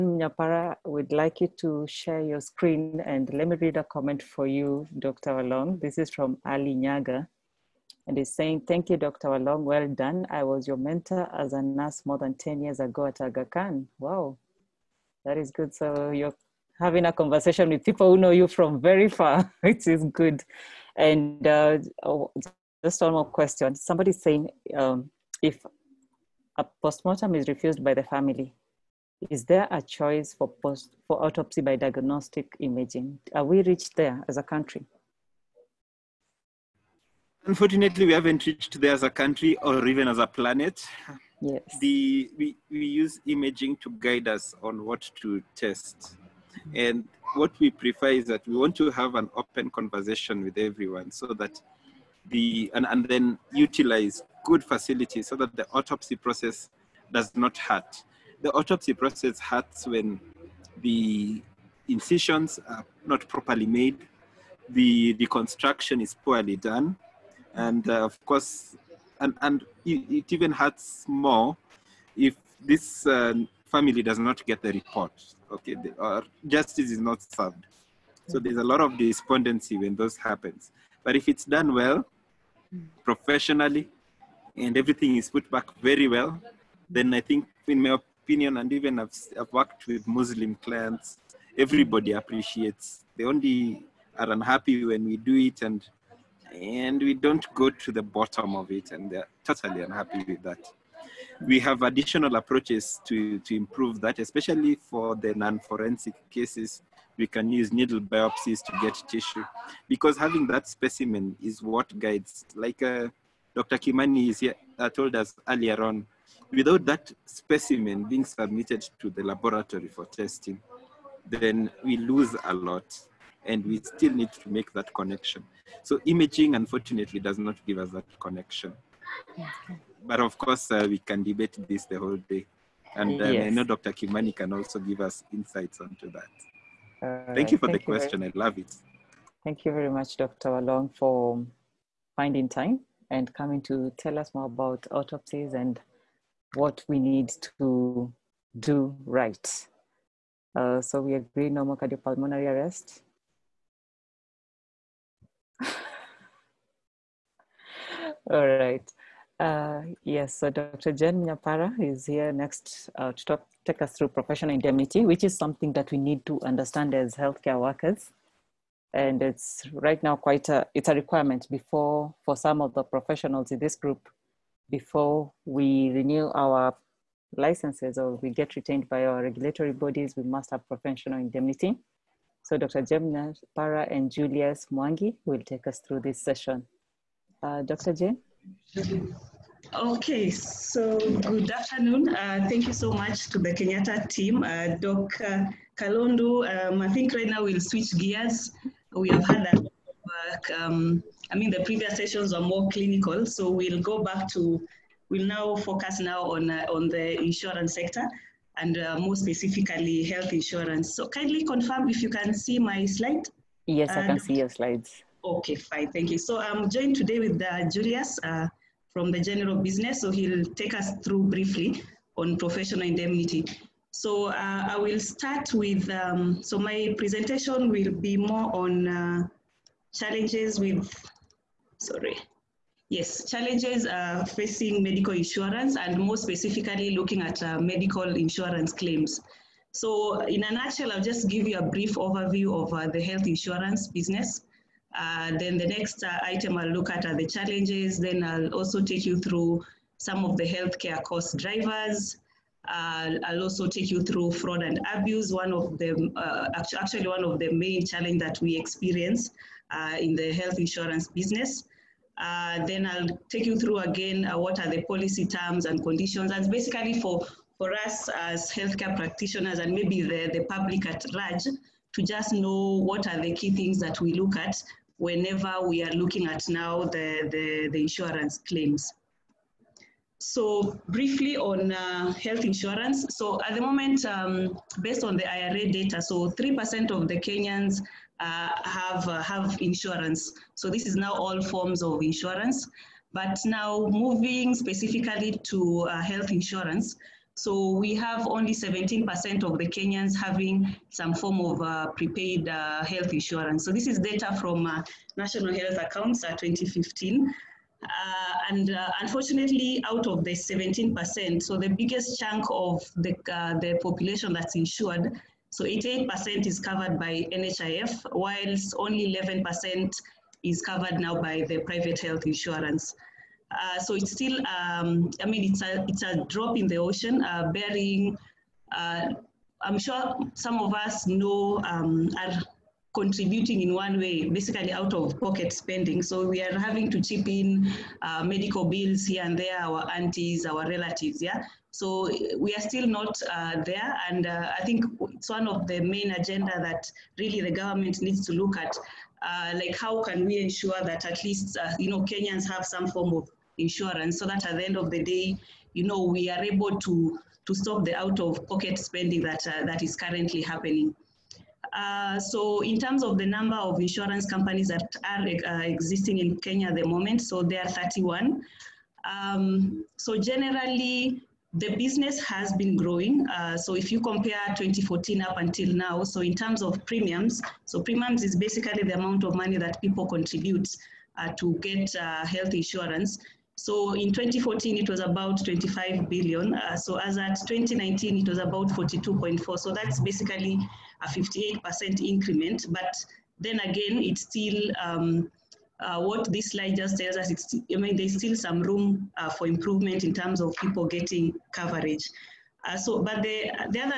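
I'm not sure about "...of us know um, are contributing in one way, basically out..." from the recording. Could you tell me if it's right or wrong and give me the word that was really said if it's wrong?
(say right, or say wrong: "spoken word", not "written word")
right.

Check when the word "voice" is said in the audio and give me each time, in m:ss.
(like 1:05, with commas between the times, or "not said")
not said.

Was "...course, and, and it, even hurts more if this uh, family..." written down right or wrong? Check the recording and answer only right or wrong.
right.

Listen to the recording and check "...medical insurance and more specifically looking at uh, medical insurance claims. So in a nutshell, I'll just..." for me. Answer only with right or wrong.
right.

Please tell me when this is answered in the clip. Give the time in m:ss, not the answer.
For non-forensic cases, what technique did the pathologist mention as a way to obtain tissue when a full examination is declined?
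1:47.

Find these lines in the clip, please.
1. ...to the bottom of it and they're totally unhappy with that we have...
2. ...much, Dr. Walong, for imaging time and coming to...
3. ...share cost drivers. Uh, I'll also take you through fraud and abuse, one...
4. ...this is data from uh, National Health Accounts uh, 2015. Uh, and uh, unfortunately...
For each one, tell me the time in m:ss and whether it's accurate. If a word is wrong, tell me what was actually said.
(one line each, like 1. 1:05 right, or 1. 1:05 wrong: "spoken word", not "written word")
1. 1:37 right
2. 2:19 wrong: "finding", not "imaging"
3. 4:10 wrong: "healthcare", not "share"
4. 5:03 right.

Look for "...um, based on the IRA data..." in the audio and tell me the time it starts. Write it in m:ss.
4:44.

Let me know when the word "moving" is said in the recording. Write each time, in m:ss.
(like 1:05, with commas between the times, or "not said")
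4:53.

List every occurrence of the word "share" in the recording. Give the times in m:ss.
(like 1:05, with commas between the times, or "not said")
0:01.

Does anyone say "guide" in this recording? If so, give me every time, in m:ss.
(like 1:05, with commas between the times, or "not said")
0:43, 1:51.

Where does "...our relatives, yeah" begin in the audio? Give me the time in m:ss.
5:40.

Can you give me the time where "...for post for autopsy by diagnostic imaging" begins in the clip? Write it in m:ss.
0:30.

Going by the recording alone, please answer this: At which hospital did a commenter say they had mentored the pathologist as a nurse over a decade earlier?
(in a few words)
Aga Khan.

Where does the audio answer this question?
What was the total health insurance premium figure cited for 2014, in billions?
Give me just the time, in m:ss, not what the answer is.
6:25.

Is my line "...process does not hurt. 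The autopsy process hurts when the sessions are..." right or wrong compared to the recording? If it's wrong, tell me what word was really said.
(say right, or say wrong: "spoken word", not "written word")
wrong: "incisions", not "sessions".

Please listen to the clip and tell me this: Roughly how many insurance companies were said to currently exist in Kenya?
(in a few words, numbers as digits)
31.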